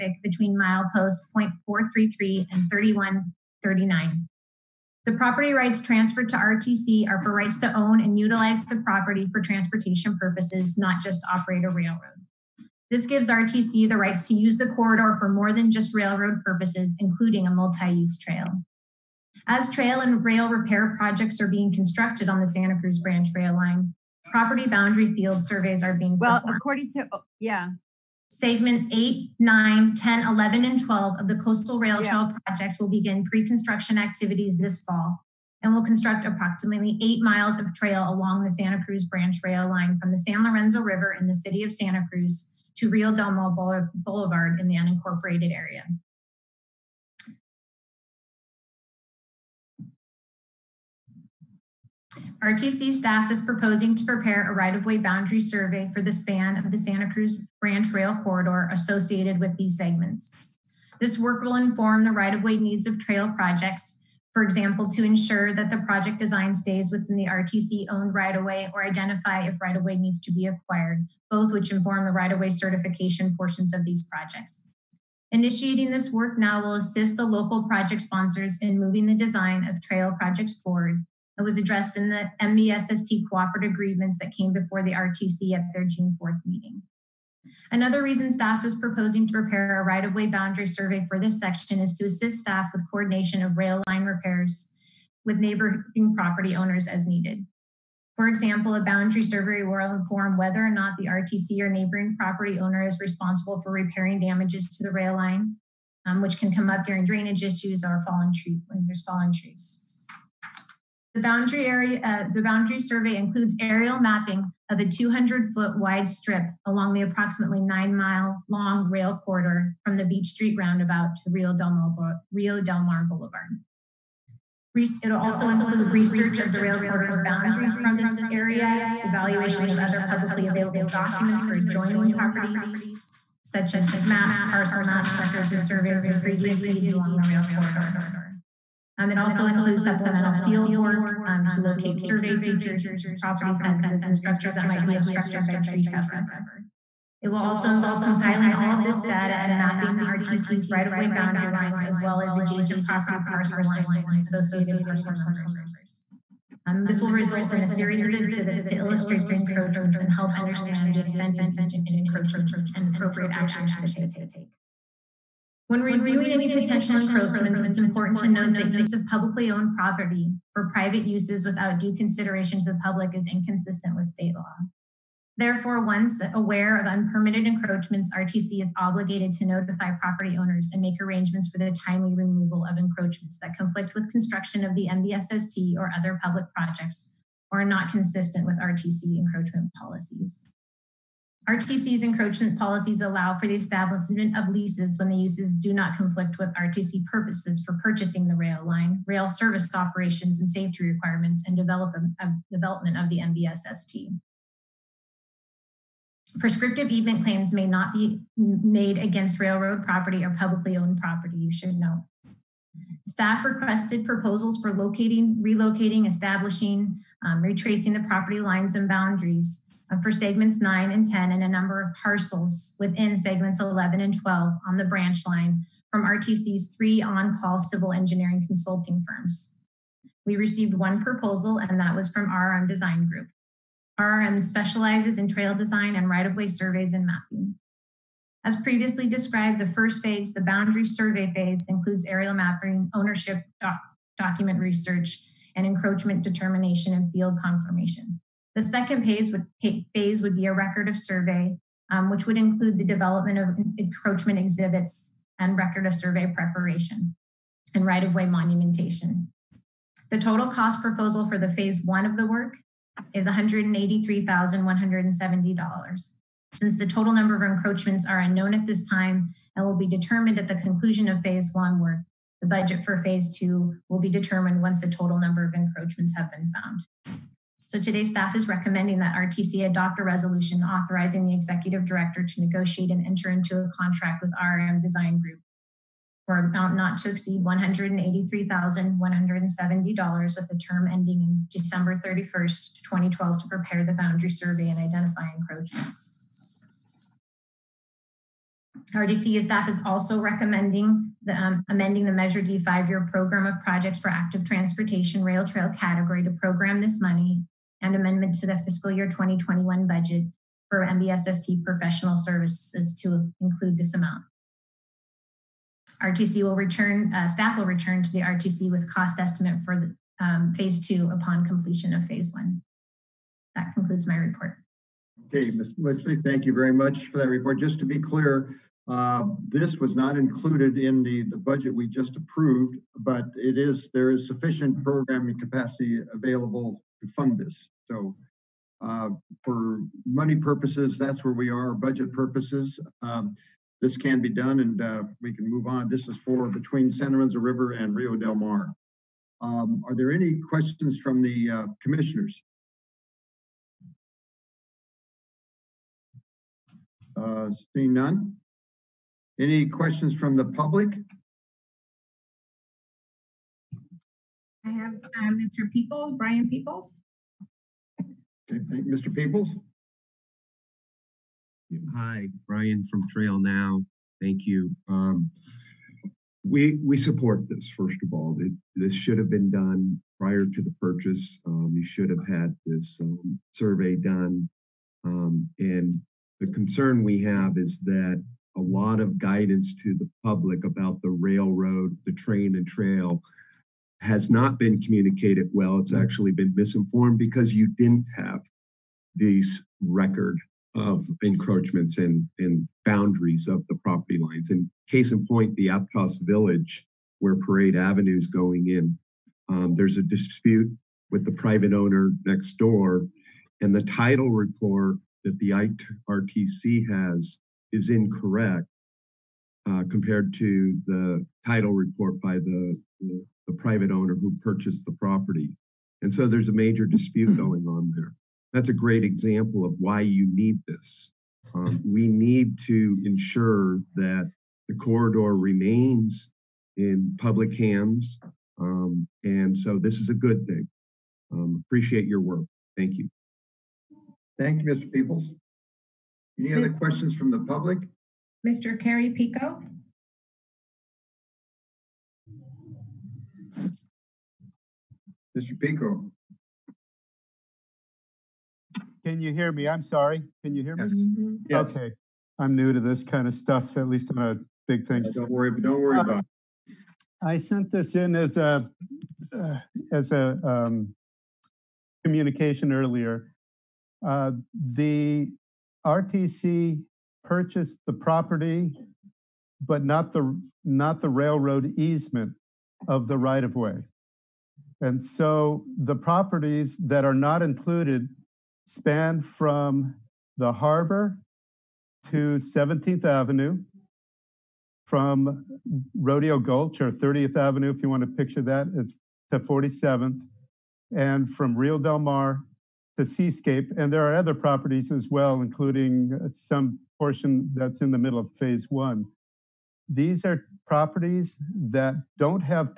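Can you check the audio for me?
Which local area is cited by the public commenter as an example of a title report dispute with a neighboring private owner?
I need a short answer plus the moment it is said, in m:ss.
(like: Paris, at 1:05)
Aptos Village, at 6:45.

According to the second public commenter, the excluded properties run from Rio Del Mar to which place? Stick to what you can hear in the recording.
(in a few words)
Seascape.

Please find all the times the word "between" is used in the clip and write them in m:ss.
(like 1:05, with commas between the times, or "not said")
0:00, 5:46.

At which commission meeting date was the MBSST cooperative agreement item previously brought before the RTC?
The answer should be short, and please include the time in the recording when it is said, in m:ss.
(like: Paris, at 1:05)
June 4th, at 1:25.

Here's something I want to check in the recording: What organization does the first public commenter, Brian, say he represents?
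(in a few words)
Trail Now.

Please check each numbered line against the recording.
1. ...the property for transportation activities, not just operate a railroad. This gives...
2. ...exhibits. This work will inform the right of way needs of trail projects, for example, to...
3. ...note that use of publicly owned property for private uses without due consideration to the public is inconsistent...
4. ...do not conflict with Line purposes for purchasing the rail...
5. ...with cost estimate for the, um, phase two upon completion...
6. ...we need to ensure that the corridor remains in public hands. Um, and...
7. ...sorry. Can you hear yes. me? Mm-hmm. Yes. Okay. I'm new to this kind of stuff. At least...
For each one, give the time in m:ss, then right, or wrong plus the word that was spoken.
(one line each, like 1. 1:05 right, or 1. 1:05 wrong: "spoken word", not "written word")
1. 0:08 wrong: "purposes", not "activities"
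2. 0:59 wrong: "segments", not "exhibits"
3. 2:48 right
4. 3:15 wrong: "RTC", not "Line"
5. 5:18 right
6. 7:11 right
7. 7:39 right.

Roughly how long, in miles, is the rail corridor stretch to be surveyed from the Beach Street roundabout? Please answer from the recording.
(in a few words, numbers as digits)
9 miles.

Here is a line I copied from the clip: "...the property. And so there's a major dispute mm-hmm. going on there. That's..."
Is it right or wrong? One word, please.
right.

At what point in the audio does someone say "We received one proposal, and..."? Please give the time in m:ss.
3:50.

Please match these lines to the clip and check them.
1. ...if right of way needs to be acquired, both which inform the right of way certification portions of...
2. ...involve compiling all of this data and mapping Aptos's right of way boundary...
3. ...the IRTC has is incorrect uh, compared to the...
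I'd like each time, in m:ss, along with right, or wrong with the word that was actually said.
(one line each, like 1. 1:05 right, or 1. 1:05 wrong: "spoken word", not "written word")
1. 1:09 right
2. 2:27 wrong: "RTC", not "Aptos"
3. 6:55 right.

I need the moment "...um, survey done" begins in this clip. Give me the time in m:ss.
6:23.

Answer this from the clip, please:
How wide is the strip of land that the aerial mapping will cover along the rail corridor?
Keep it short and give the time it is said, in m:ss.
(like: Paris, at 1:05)
200 feet, at 1:54.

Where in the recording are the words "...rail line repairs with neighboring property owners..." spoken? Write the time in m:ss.
1:33.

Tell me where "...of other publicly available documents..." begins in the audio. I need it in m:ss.
2:09.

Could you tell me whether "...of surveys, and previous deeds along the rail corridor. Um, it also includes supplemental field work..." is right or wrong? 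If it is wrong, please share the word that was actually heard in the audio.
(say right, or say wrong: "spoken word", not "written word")
right.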